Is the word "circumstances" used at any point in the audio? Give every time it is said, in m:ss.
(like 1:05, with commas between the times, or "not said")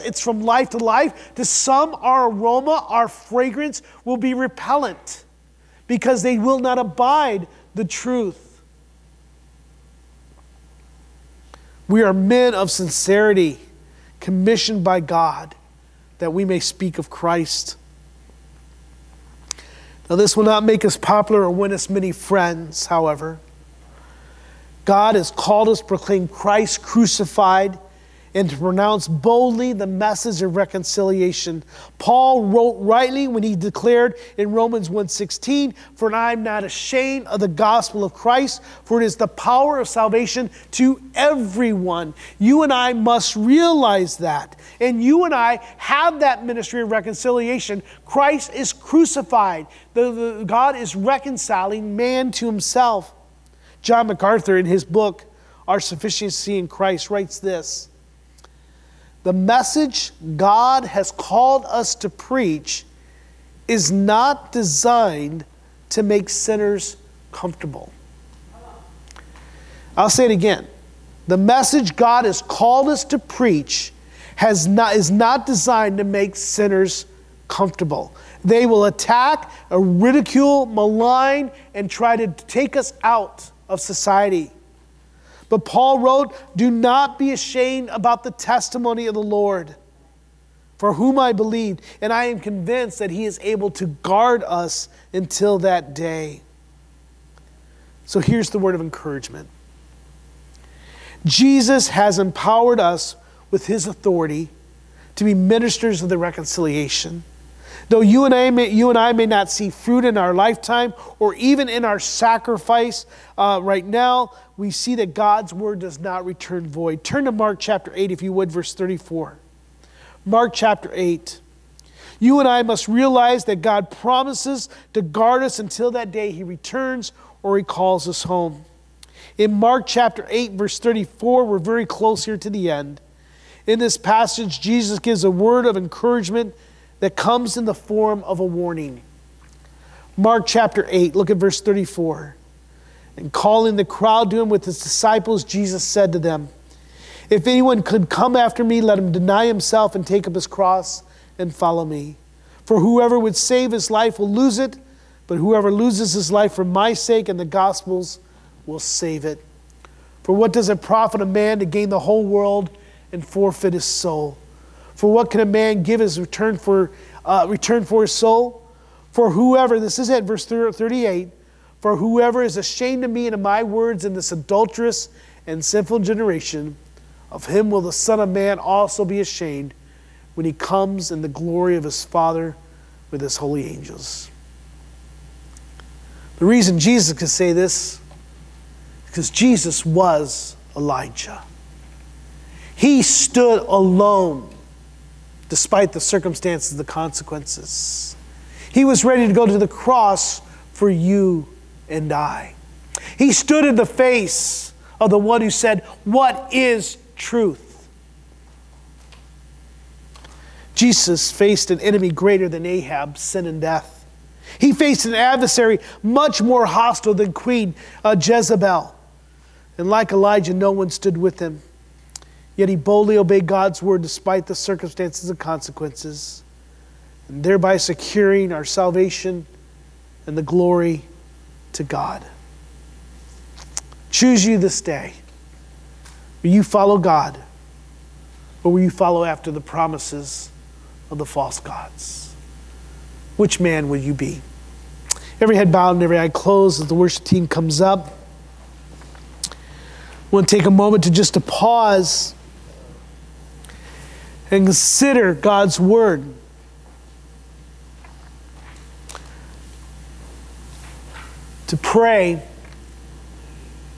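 3:16, 3:44.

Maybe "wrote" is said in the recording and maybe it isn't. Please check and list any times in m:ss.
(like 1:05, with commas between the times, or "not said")
0:32, 1:26.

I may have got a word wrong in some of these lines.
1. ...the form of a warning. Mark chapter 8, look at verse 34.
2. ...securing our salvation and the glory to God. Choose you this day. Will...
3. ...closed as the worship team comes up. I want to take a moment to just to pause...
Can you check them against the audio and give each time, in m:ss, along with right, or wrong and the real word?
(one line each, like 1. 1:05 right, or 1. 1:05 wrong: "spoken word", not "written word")
1. 2:17 right
2. 3:47 right
3. 4:06 right.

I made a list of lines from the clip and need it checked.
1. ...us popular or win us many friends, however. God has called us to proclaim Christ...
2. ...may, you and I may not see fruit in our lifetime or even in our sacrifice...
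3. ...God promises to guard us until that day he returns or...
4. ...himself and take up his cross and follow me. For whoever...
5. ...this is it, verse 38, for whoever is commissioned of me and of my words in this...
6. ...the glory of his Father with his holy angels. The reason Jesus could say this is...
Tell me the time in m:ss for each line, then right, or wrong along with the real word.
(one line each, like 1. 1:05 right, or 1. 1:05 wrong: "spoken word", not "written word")
1. 0:20 right
2. 1:48 right
3. 2:03 right
4. 2:29 right
5. 2:49 wrong: "ashamed", not "commissioned"
6. 3:01 right.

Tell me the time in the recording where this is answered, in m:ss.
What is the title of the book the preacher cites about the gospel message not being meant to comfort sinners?
0:55.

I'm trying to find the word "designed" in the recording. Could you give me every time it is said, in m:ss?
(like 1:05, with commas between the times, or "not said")
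1:04, 1:15.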